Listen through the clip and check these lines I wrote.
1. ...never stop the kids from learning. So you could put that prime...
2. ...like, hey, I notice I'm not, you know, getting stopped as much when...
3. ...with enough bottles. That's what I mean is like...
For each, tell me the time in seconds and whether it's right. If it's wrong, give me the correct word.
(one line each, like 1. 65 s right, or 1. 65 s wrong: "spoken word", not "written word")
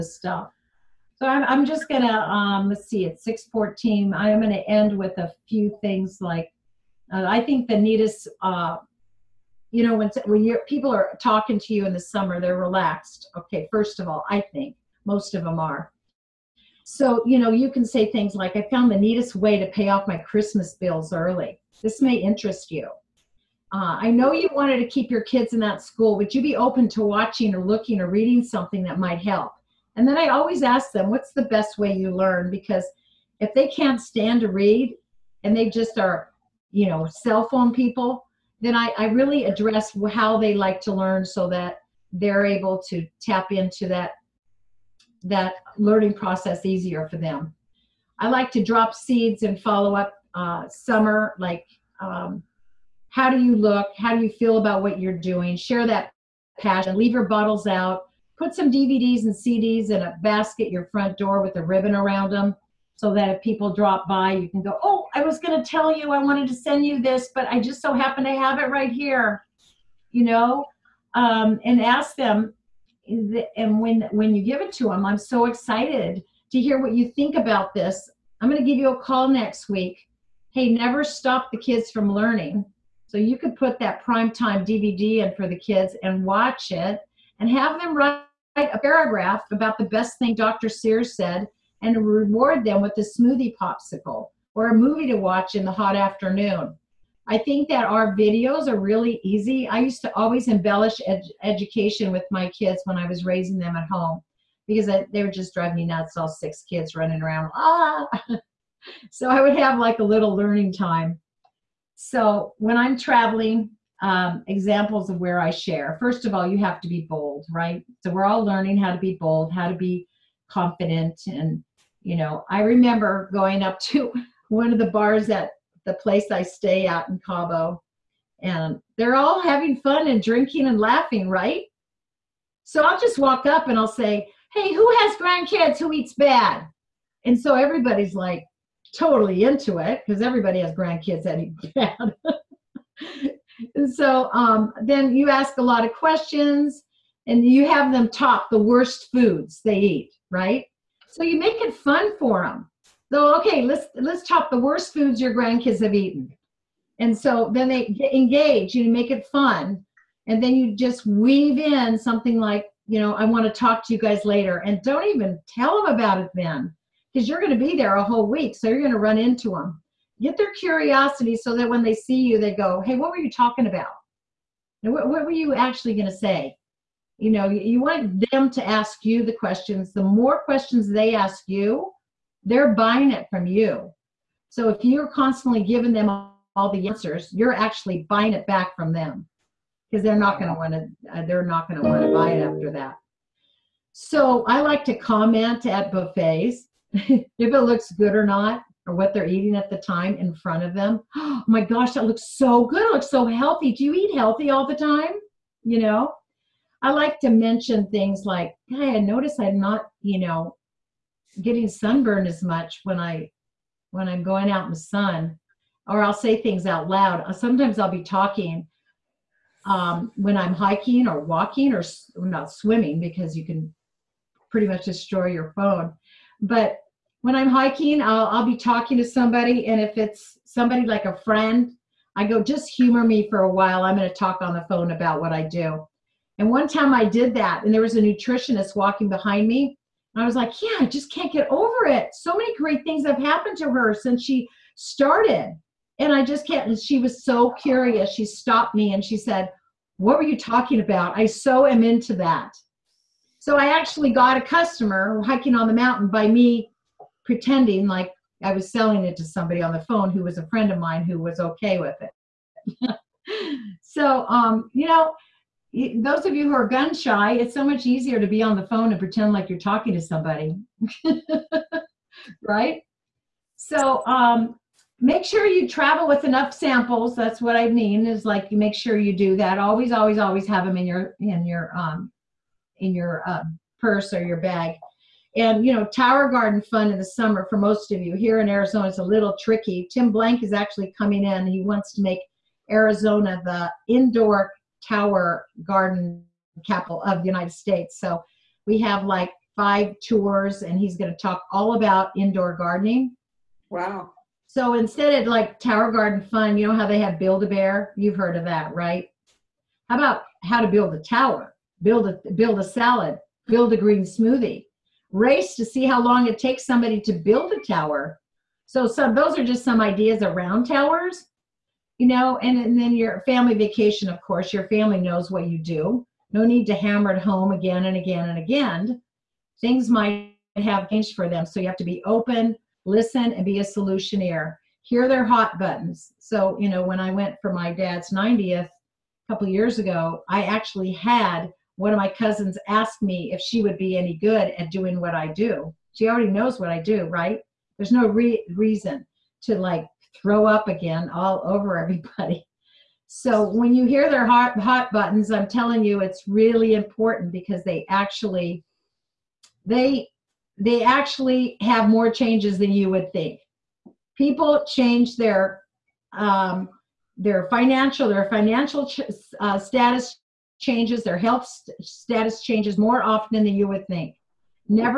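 1. 80 s right
2. 208 s wrong: "sunburned", not "stopped"
3. 276 s wrong: "samples", not "bottles".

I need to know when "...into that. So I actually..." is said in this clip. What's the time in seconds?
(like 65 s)
251 s.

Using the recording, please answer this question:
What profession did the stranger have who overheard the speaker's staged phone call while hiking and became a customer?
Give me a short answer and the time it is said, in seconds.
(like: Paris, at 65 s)
Nutritionist, at 238 s.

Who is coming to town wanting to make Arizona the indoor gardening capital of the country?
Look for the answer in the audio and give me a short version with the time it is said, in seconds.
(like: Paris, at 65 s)
Tim Blank, at 289 s.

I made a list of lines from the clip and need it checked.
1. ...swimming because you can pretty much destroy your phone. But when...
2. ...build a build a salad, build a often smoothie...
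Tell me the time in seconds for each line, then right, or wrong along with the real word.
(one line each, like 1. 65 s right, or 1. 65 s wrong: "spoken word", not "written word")
1. 222 s right
2. 311 s wrong: "green", not "often".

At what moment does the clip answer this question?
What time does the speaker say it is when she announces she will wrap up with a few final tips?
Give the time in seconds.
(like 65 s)
3 s.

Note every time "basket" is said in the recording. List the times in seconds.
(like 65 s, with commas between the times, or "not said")
60 s.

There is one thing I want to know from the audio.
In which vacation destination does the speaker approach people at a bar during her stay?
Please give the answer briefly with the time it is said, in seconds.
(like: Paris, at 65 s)
Cabo, at 127 s.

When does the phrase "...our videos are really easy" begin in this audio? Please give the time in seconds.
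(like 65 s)
97 s.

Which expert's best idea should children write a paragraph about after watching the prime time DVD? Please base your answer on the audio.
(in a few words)
Dr. Sears.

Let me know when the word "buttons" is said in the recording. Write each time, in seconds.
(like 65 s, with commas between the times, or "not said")
335 s, 354 s.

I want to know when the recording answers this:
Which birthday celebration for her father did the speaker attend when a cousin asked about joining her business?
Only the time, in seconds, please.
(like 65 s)
338 s.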